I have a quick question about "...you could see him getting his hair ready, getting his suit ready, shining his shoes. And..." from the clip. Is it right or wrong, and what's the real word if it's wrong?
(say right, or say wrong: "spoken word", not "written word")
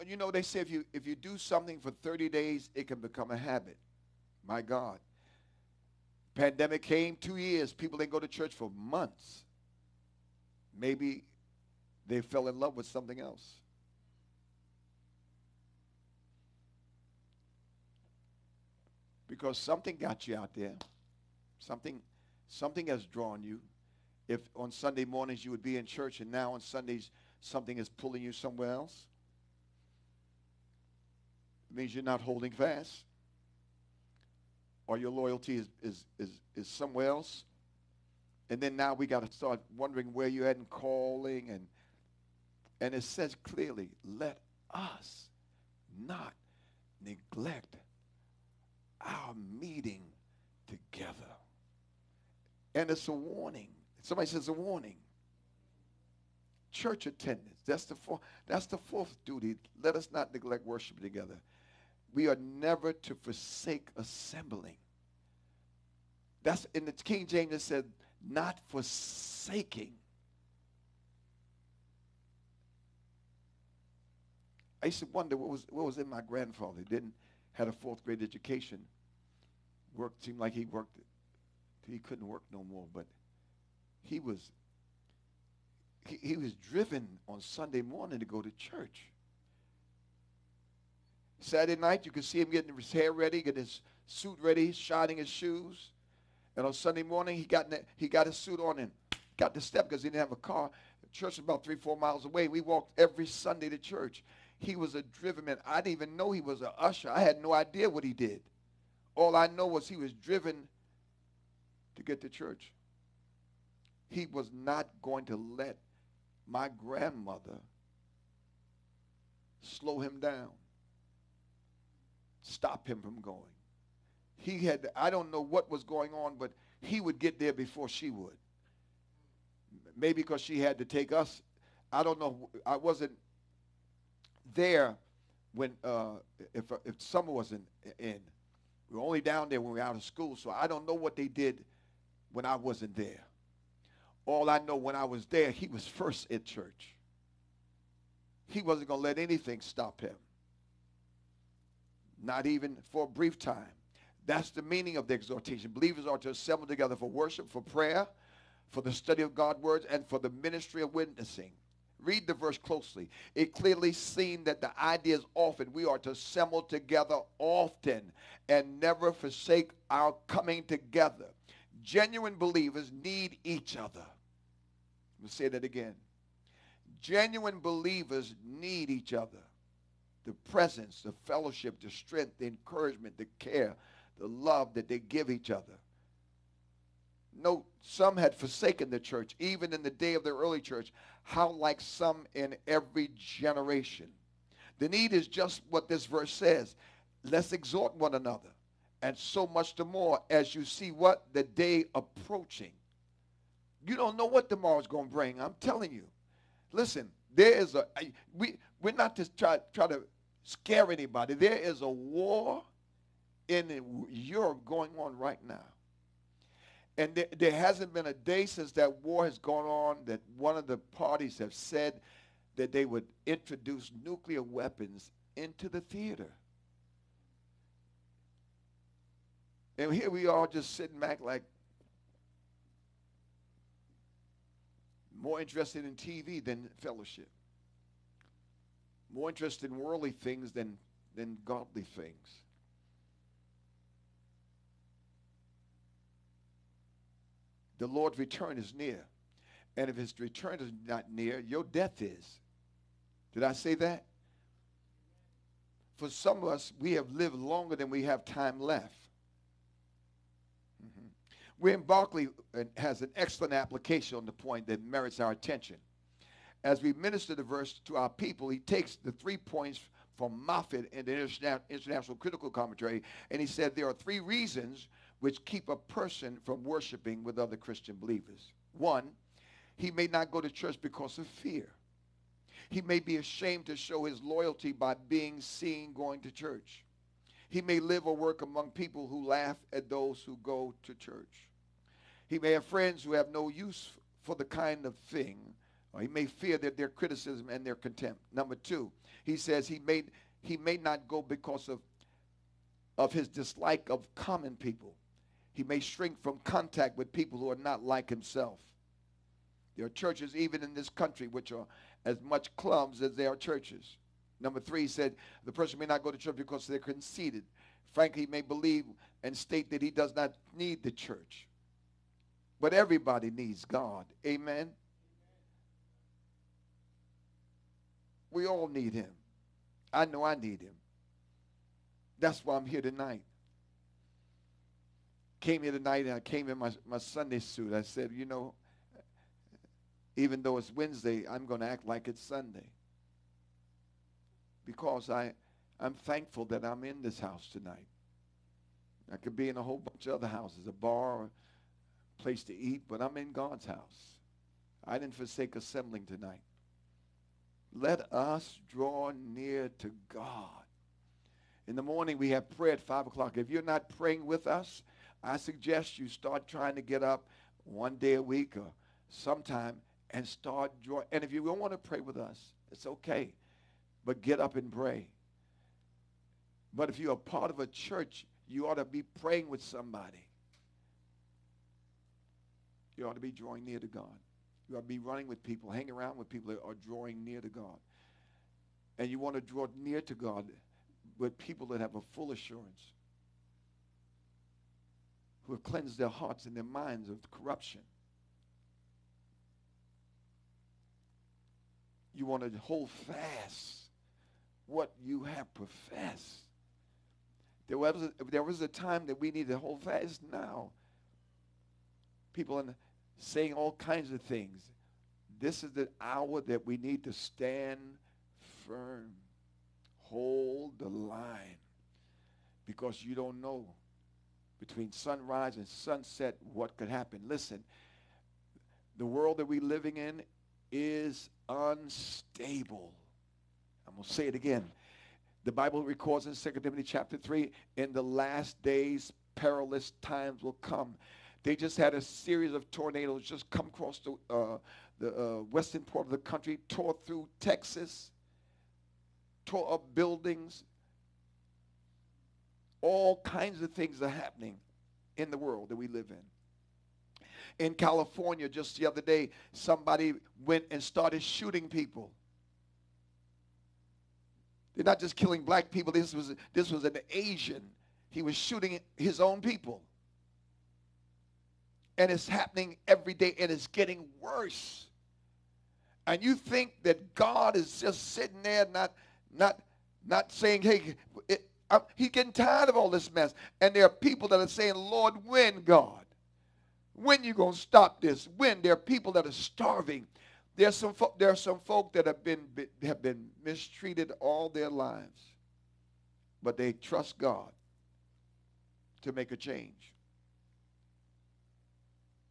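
right.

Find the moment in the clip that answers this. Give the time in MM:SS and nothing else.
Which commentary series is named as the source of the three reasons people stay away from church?
04:31.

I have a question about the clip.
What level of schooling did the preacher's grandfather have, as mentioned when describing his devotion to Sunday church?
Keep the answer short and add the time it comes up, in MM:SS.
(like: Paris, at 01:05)
Fourth grade, at 01:17.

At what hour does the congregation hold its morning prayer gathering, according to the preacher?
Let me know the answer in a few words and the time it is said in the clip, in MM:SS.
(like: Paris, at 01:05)
5 o'clock, at 06:02.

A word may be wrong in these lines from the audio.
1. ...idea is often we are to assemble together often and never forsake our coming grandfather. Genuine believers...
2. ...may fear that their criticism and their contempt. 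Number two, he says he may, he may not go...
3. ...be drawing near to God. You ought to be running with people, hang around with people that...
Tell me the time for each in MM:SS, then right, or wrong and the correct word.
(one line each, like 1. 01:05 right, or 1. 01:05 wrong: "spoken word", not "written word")
1. 02:44 wrong: "together", not "grandfather"
2. 04:56 right
3. 06:23 right.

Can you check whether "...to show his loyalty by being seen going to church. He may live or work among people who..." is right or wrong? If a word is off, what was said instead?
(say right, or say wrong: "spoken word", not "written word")
right.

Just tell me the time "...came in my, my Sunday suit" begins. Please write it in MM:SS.
05:36.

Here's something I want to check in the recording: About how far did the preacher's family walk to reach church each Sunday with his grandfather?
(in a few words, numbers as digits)
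3 to 4 miles.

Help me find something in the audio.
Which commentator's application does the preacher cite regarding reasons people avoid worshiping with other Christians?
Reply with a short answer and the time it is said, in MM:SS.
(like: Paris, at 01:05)
William Barclay, at 04:21.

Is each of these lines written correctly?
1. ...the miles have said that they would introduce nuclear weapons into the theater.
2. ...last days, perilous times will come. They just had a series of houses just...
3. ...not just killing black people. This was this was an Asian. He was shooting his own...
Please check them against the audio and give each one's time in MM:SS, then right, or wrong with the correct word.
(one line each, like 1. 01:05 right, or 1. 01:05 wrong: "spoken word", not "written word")
1. 03:40 wrong: "parties", not "miles"
2. 07:18 wrong: "tornadoes", not "houses"
3. 07:44 right.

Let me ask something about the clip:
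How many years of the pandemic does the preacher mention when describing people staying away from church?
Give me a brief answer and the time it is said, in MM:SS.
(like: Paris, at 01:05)
2, at 00:07.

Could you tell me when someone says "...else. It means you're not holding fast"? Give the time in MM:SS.
00:28.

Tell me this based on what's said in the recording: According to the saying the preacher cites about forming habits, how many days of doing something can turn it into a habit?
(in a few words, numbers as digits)
30.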